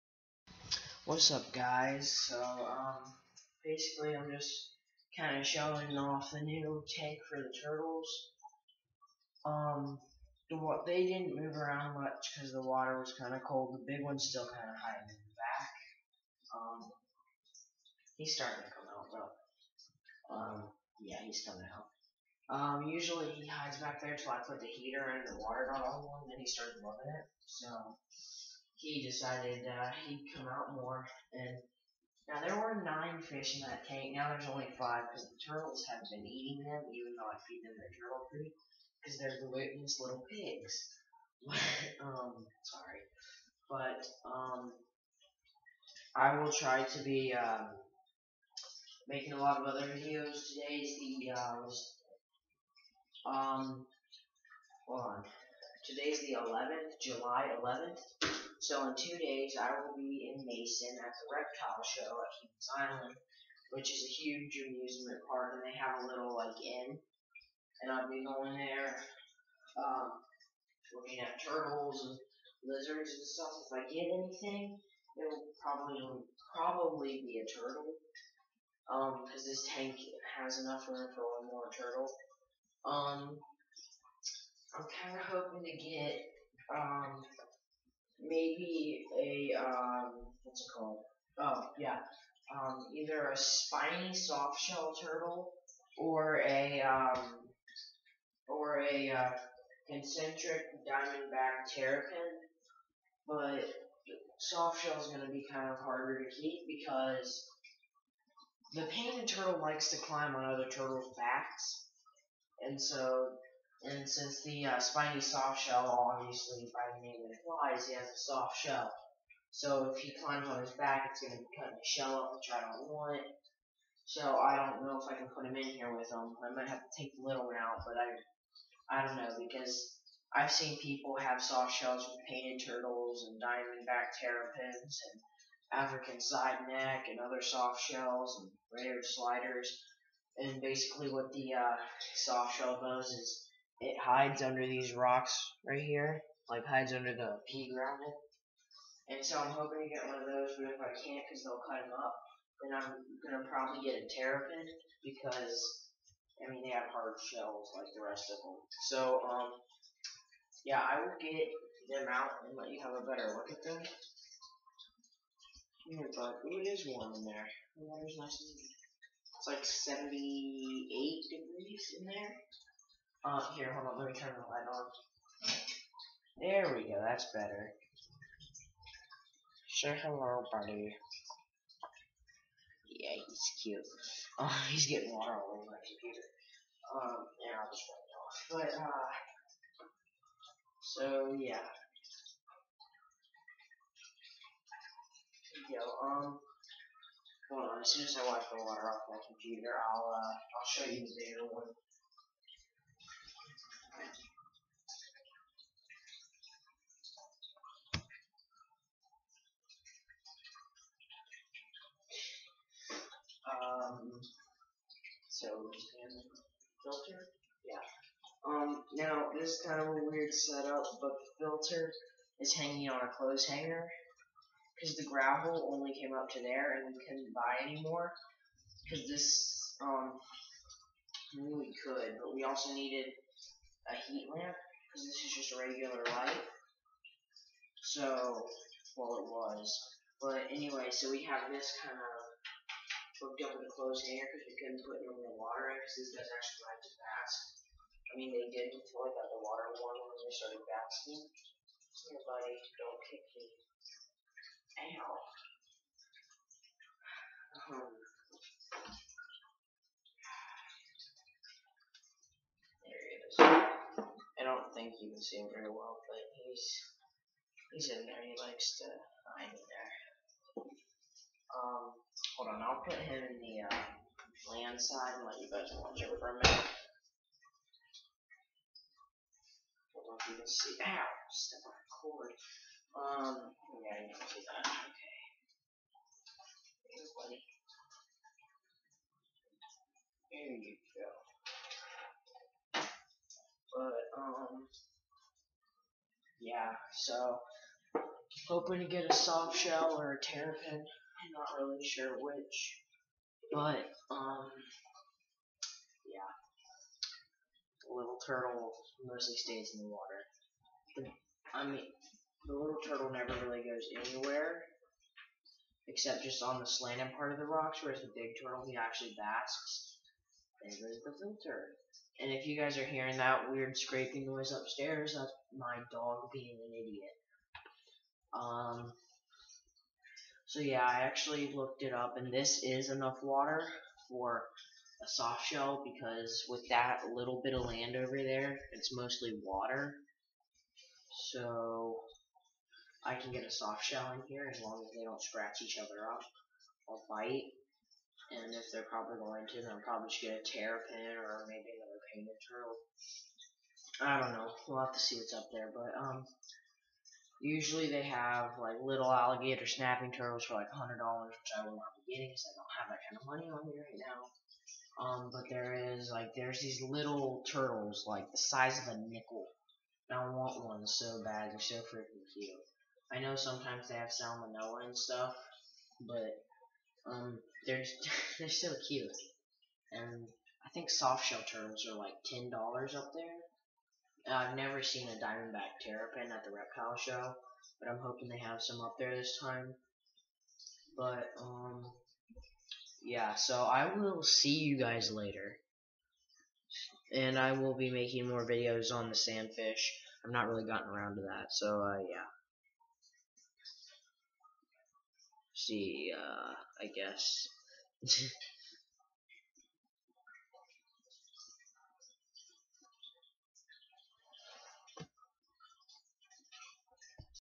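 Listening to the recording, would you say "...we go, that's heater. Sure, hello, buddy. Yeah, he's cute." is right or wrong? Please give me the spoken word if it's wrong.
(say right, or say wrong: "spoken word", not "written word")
wrong: "better", not "heater".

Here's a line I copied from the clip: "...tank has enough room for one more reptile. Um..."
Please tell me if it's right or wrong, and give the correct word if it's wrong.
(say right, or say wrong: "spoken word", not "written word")
wrong: "turtle", not "reptile".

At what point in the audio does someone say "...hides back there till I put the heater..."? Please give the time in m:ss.
0:23.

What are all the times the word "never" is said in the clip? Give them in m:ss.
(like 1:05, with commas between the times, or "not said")
5:13, 6:24.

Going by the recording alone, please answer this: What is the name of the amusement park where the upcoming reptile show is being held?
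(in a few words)
Humans Island.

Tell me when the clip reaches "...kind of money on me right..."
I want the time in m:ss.
6:03.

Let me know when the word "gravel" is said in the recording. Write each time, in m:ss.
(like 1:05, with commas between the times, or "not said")
2:27, 3:45.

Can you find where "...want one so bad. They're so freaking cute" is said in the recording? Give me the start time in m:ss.
6:10.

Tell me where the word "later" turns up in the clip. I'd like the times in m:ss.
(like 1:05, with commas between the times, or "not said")
6:35.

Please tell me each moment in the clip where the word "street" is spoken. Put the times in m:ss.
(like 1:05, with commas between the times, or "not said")
not said.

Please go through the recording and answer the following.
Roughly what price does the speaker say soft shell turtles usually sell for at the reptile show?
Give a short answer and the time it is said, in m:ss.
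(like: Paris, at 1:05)
$10, at 6:22.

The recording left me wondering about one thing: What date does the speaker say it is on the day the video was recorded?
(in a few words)
July 11th.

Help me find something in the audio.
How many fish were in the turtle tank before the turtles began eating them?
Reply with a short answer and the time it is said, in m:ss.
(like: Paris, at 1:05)
9, at 0:32.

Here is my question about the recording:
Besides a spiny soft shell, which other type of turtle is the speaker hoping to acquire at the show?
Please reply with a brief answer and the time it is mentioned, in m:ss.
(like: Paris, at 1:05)
concentric diamondback terrapin, at 1:39.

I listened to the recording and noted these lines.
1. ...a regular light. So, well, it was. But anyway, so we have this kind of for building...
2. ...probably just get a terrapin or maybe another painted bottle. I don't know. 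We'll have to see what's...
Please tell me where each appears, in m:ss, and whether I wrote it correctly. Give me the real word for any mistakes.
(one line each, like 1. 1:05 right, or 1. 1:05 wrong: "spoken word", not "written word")
1. 3:55 right
2. 5:49 wrong: "turtle", not "bottle".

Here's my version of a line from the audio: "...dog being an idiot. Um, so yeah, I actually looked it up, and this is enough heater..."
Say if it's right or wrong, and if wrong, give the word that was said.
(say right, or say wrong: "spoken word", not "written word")
wrong: "water", not "heater".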